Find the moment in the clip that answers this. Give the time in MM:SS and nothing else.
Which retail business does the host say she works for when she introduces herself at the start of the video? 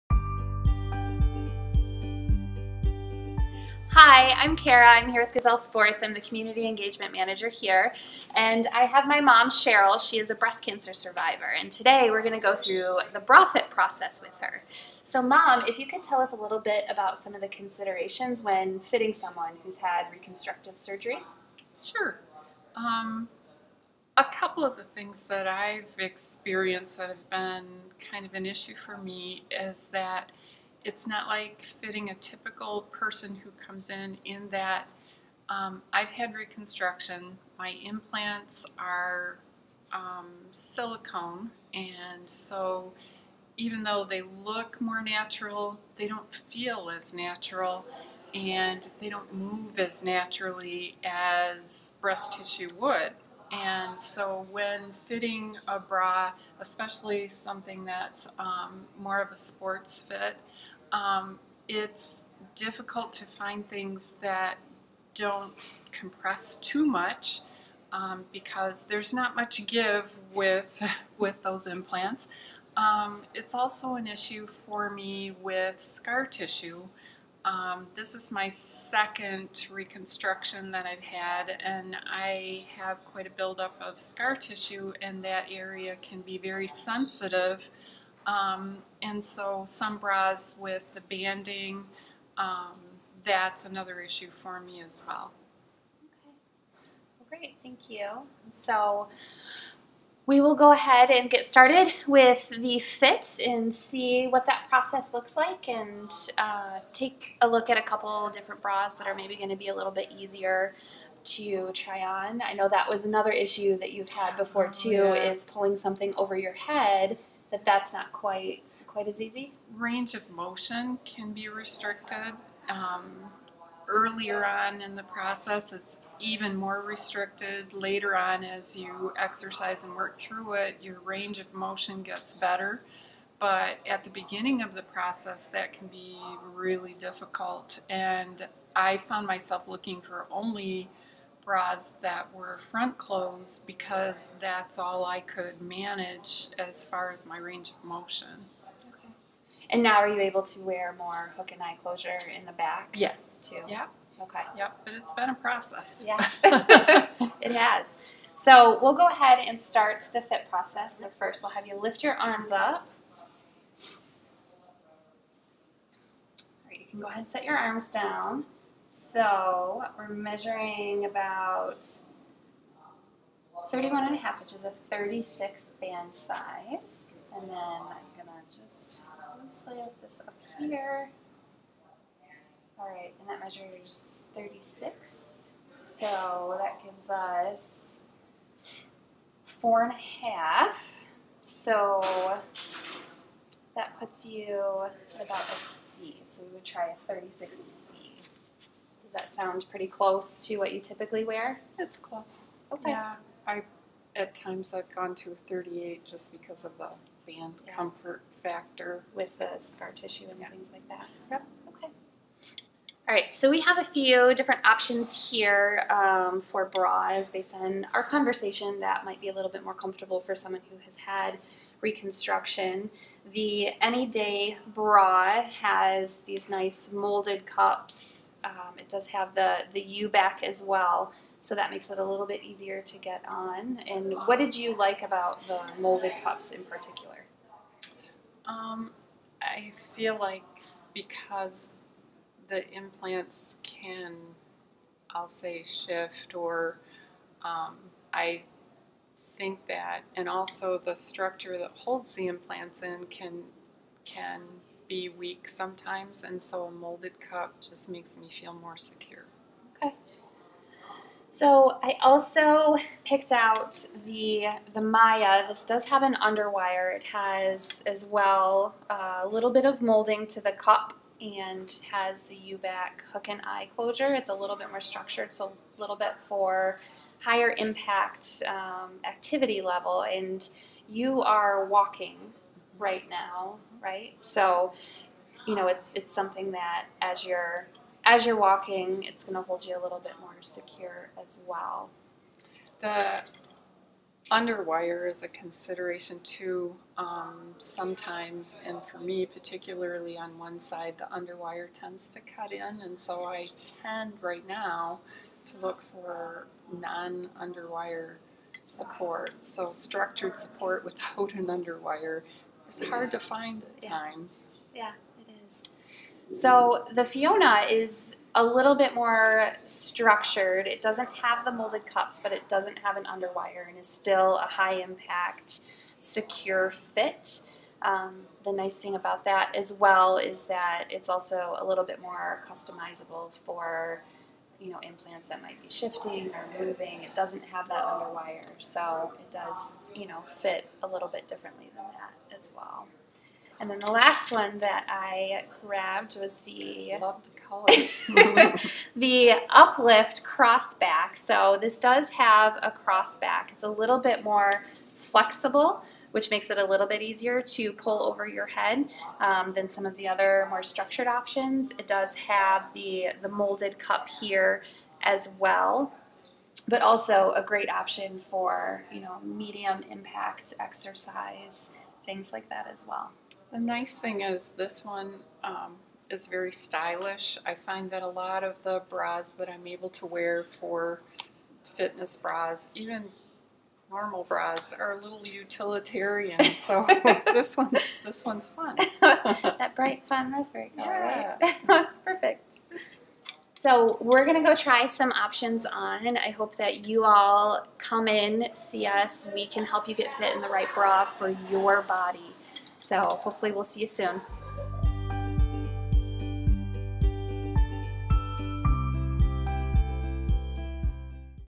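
00:05.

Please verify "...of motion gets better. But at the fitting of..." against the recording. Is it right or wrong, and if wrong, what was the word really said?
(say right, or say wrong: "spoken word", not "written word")
wrong: "beginning", not "fitting".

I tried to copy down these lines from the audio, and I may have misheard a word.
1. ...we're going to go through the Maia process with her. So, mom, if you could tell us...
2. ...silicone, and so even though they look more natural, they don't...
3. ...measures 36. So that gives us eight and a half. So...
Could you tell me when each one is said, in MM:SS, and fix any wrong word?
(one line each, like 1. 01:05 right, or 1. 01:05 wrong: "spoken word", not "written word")
1. 00:12 wrong: "BRAFIT", not "Maia"
2. 00:40 right
3. 03:03 wrong: "four", not "eight".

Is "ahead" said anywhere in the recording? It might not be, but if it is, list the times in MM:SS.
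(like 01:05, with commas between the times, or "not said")
01:40, 02:39, 02:47.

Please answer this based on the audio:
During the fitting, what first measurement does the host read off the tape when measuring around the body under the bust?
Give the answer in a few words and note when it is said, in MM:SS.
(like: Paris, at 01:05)
31.5, at 02:53.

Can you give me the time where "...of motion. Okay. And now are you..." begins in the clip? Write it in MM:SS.
02:27.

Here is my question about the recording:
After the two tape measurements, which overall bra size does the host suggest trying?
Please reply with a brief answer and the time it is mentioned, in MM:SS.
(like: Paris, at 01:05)
36C, at 03:17.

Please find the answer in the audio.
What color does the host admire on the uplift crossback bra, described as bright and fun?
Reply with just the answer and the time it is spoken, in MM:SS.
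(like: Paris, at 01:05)
Raspberry, at 06:30.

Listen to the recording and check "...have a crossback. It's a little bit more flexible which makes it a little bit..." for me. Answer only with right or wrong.
right.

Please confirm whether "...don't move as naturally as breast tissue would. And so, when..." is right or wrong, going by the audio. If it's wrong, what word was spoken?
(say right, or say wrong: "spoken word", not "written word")
right.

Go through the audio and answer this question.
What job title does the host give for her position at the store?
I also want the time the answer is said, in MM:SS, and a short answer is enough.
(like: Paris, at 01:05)
Community Engagement Manager, at 00:06.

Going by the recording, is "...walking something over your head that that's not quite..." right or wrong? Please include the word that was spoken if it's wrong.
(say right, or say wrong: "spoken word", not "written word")
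wrong: "pulling", not "walking".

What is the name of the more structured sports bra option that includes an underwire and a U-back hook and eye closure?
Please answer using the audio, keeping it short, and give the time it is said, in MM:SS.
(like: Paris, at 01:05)
Maia, at 04:24.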